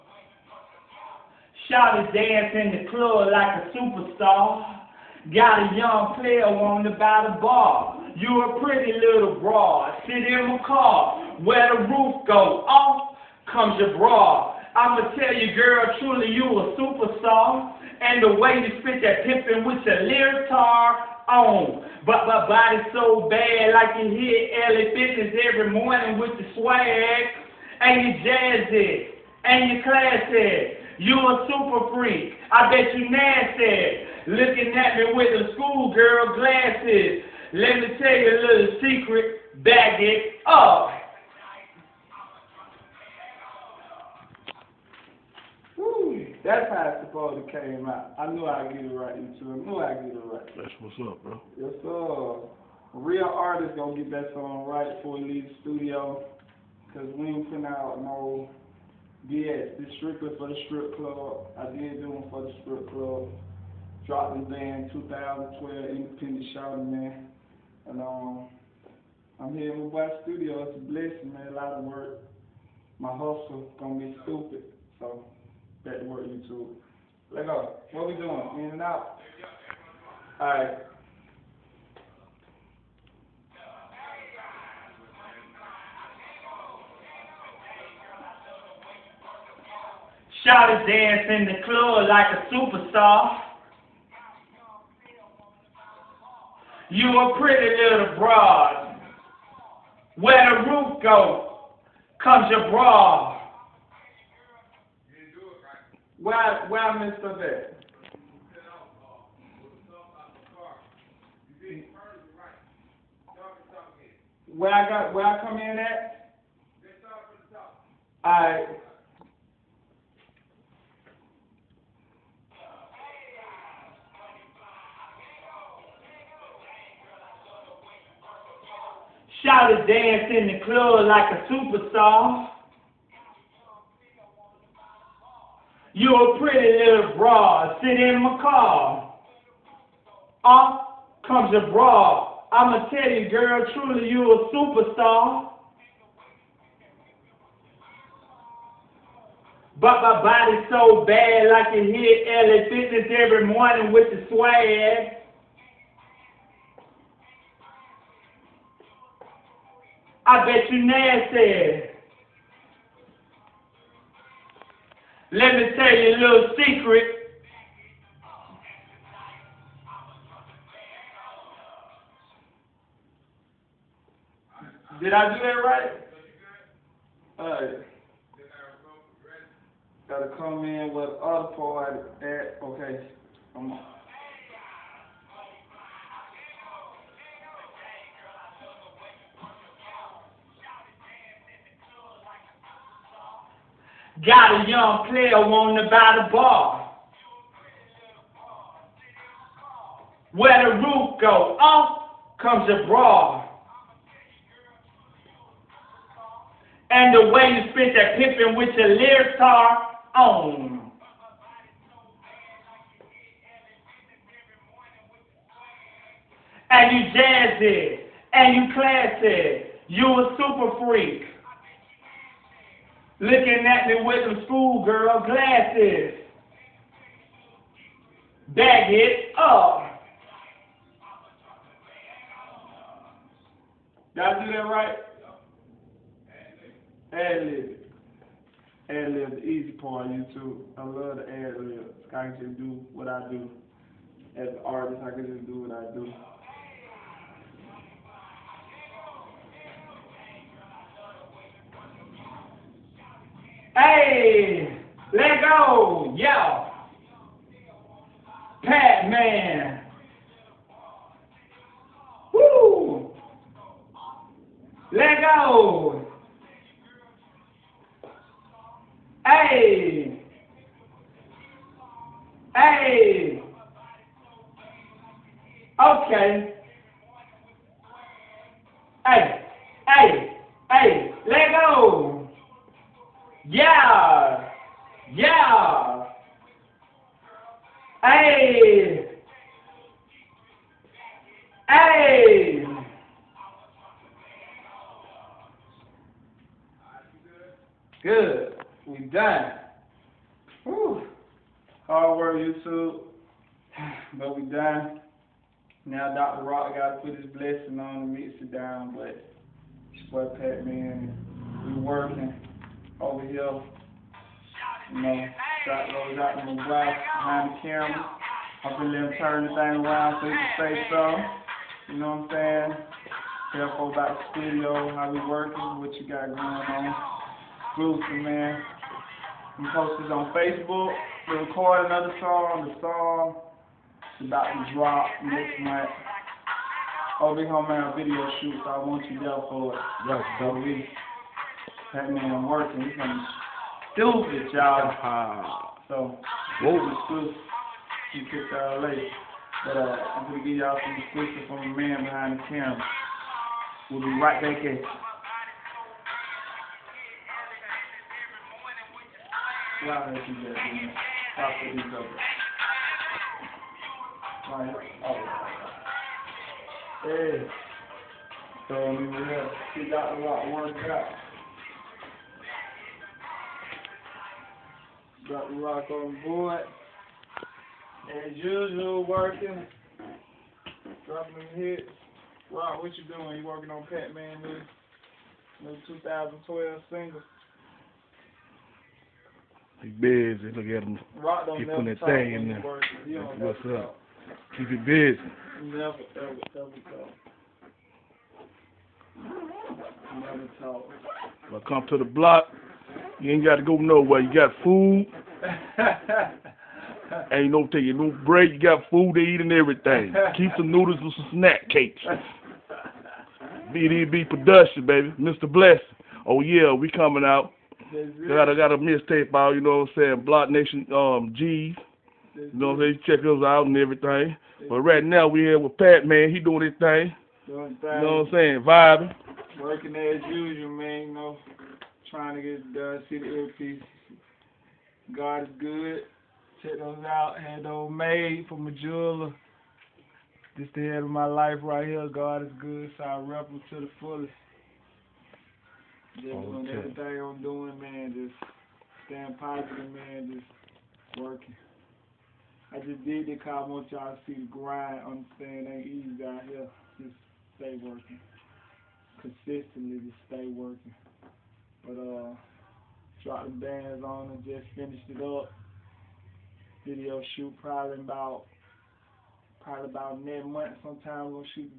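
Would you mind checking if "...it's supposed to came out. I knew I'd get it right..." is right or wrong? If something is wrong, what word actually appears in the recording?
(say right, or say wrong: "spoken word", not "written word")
right.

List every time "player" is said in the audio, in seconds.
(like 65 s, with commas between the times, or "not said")
6 s, 195 s.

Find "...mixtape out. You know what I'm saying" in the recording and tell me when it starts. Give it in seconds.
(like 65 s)
418 s.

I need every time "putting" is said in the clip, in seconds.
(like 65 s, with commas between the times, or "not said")
57 s.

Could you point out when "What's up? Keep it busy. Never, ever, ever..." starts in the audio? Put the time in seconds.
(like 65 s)
393 s.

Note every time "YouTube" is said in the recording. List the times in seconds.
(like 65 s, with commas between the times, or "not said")
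76 s, 240 s.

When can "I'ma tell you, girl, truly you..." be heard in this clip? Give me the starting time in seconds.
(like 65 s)
142 s.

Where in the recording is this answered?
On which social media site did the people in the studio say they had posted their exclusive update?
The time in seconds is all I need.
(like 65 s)
330 s.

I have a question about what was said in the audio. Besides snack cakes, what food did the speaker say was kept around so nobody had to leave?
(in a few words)
Noodles.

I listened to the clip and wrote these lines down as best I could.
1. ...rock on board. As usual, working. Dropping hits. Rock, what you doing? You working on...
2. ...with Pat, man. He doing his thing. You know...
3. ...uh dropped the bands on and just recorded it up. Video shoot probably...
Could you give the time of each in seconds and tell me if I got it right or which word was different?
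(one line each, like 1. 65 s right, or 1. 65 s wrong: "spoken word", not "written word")
1. 375 s right
2. 425 s right
3. 461 s wrong: "finished", not "recorded".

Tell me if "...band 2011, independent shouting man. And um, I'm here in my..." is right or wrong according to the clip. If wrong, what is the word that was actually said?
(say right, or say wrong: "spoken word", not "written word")
wrong: "2012", not "2011".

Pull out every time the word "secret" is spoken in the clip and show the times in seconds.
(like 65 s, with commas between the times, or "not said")
38 s, 166 s.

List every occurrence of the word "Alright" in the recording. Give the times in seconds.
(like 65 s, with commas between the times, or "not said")
177 s.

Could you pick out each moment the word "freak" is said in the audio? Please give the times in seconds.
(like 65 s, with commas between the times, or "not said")
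31 s, 220 s.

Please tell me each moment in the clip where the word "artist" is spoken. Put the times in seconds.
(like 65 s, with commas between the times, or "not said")
53 s, 244 s.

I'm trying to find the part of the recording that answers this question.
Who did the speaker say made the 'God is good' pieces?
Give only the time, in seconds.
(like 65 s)
438 s.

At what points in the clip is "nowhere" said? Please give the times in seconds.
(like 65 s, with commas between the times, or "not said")
403 s.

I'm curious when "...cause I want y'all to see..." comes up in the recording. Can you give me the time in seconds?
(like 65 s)
453 s.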